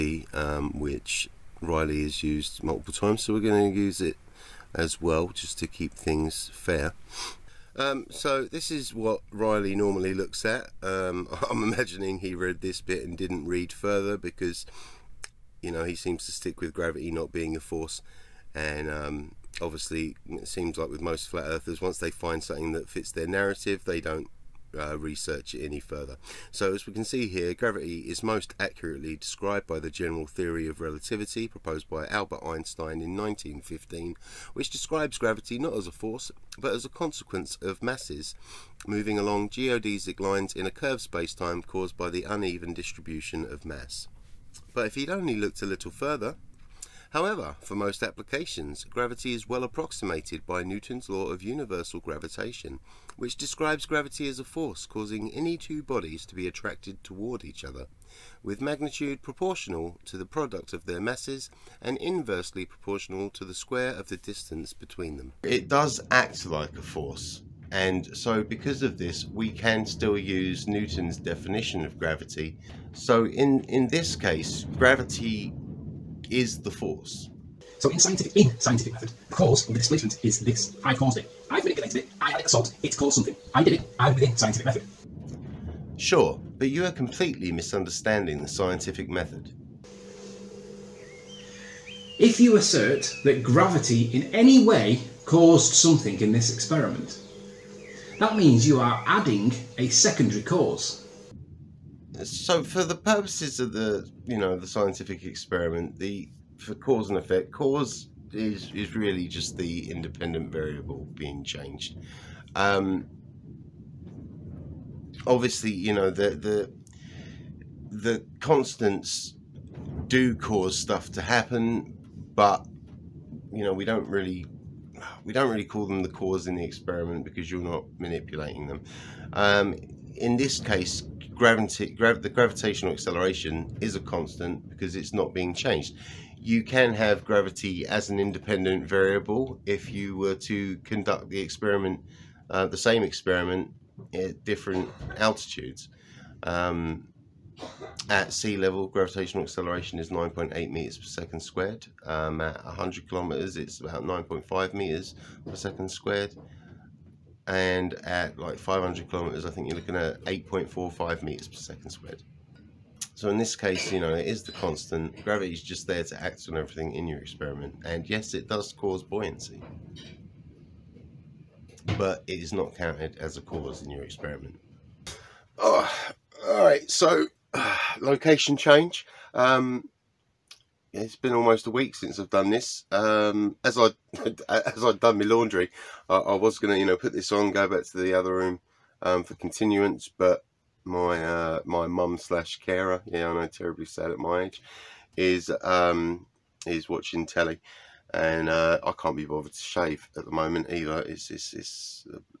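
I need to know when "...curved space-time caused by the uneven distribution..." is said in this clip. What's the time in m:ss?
0:40.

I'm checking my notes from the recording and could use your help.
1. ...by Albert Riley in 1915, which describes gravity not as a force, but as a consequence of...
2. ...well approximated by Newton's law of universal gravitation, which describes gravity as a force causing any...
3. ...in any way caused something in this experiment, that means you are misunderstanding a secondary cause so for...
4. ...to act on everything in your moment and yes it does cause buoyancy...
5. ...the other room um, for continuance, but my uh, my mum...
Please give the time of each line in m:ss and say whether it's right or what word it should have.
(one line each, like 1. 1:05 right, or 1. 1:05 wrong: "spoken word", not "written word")
1. 0:31 wrong: "Einstein", not "Riley"
2. 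0:49 right
3. 1:34 wrong: "adding", not "misunderstanding"
4. 2:46 wrong: "experiment", not "moment"
5. 3:07 right.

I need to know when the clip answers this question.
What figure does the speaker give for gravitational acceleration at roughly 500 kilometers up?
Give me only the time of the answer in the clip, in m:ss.
2:40.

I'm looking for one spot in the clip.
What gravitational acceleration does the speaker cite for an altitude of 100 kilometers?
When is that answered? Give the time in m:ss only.
2:34.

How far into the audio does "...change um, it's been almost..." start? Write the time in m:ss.
2:58.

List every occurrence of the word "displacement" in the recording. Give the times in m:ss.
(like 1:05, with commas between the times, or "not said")
1:19.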